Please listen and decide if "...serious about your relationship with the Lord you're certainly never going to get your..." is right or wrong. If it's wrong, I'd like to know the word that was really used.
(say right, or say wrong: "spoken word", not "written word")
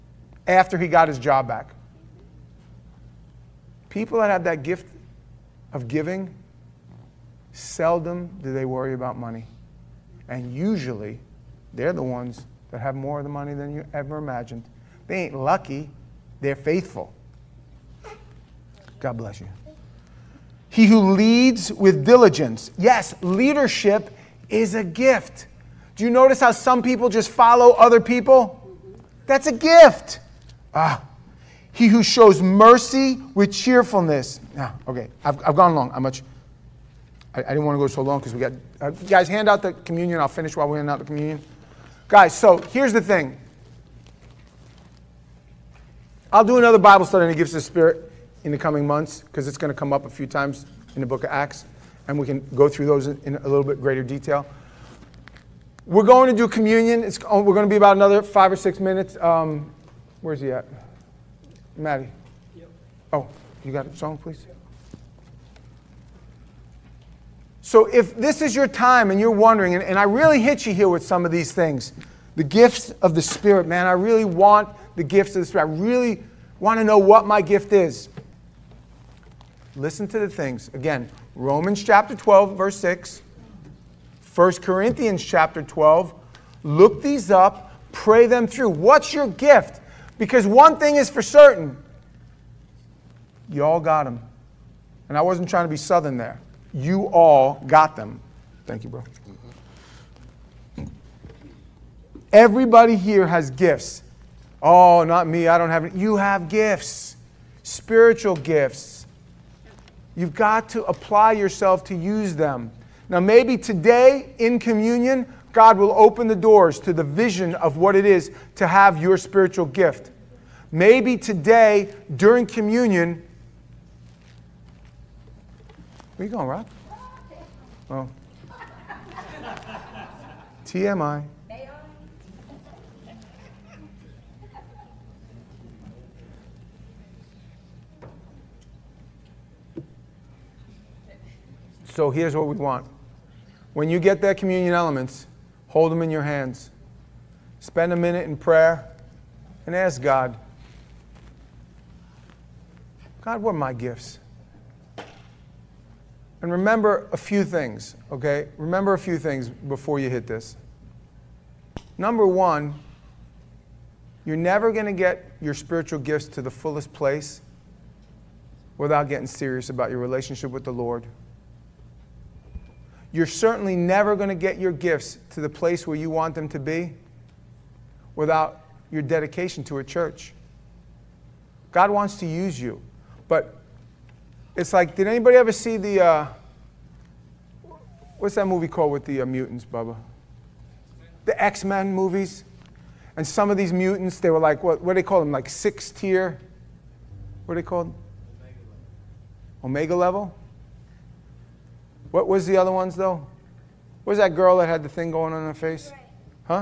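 right.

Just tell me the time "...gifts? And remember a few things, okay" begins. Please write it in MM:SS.
02:33.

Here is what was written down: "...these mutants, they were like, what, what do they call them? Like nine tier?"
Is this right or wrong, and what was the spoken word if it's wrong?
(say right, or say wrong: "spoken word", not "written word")
wrong: "six", not "nine".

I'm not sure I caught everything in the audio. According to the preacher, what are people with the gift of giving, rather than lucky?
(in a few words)
Faithful.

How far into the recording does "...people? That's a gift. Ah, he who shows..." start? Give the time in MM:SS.
00:28.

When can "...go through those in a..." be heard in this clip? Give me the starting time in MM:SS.
00:52.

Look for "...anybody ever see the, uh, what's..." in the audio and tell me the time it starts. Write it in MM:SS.
03:05.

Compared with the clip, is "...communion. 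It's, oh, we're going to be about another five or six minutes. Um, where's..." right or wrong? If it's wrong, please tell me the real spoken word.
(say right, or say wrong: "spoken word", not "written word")
right.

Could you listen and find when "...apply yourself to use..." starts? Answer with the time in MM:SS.
01:50.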